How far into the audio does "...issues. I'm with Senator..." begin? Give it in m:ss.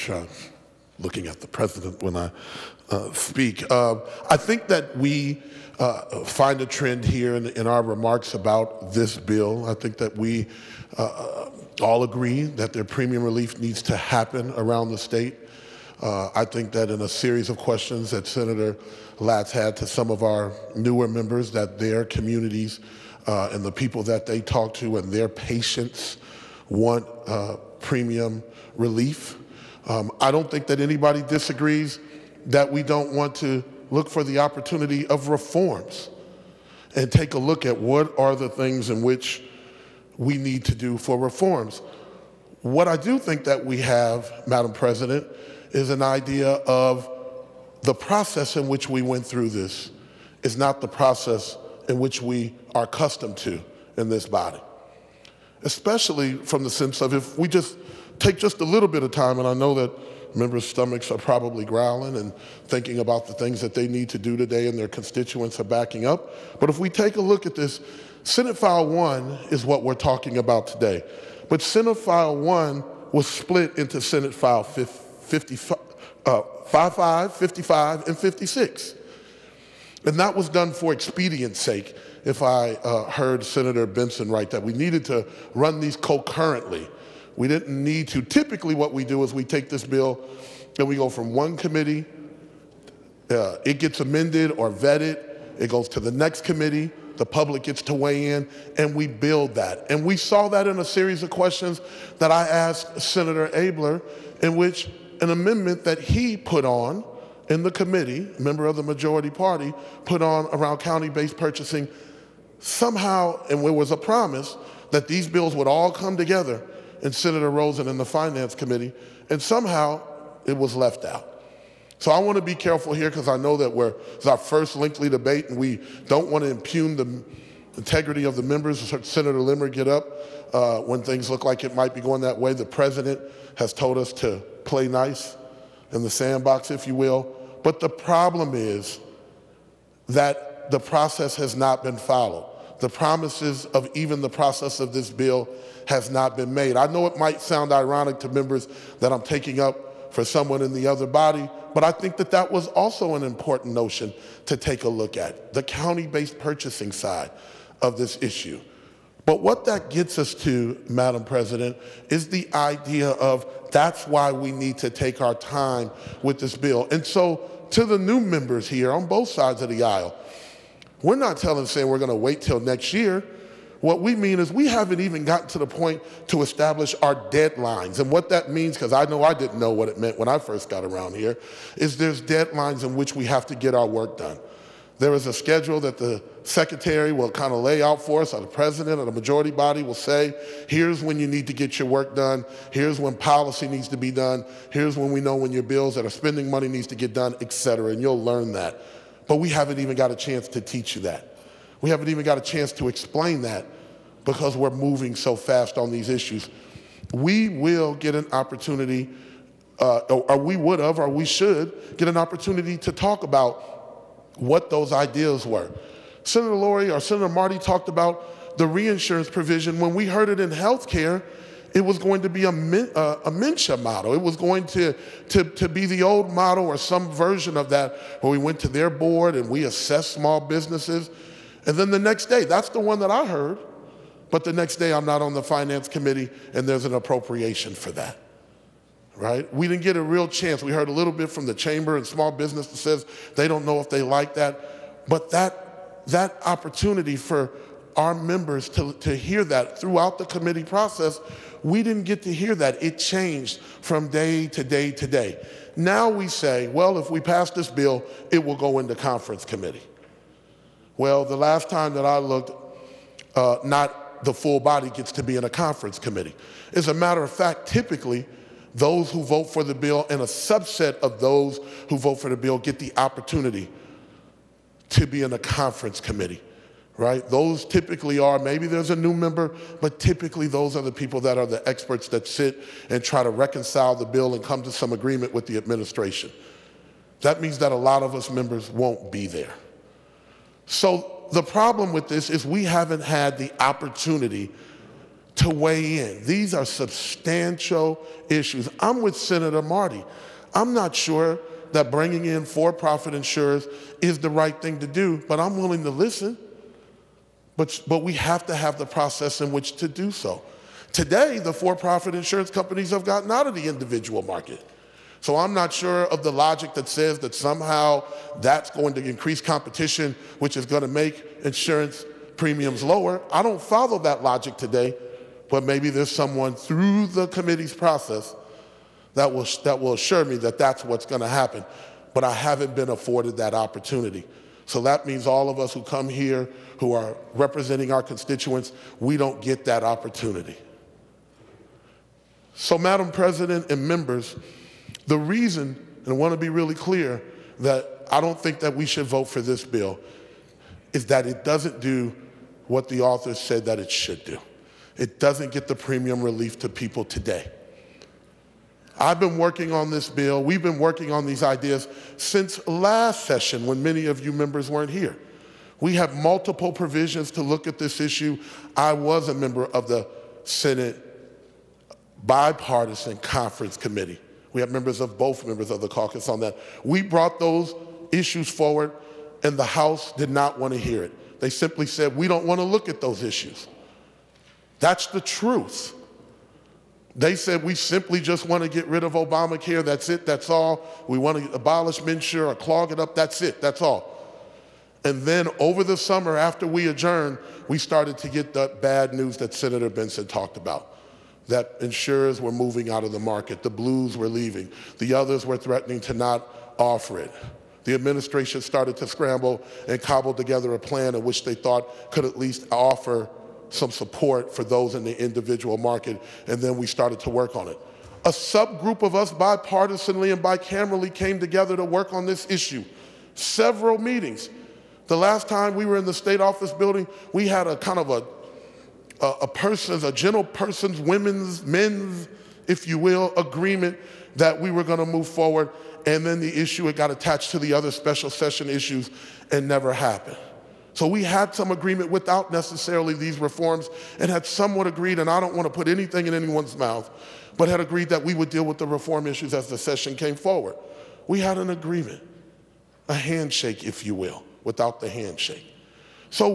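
4:58.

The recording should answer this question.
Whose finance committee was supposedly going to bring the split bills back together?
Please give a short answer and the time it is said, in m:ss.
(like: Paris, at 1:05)
Senator Rosen, at 1:57.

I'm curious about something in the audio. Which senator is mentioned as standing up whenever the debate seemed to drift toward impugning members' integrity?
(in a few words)
Senator Limmer.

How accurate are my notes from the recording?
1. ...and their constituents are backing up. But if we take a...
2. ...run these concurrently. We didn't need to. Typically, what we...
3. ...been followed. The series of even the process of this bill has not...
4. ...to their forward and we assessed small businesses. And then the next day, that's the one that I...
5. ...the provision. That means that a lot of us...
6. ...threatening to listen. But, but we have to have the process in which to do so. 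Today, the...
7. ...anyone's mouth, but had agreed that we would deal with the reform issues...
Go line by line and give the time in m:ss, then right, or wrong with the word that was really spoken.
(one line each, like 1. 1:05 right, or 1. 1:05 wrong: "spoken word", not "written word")
1. 1:04 right
2. 1:25 right
3. 2:21 wrong: "promises", not "series"
4. 3:48 wrong: "board", not "forward"
5. 4:45 wrong: "administration", not "provision"
6. 5:05 wrong: "willing", not "threatening"
7. 7:26 right.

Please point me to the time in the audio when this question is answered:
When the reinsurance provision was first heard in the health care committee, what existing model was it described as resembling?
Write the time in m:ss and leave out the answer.
3:43.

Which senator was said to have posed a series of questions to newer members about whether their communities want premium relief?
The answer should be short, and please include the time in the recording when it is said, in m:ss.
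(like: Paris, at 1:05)
Senator Latz, at 0:18.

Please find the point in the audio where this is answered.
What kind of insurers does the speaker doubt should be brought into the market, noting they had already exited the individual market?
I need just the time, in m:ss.
5:02.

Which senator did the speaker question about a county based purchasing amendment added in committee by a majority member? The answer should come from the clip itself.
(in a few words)
Senator Abeler.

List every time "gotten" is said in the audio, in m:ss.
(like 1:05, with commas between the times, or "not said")
2:55, 5:13.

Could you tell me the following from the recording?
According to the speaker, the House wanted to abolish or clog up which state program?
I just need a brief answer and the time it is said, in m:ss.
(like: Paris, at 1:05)
MNsure, at 6:32.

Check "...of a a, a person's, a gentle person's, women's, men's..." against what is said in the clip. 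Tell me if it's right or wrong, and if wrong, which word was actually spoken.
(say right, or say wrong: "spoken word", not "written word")
right.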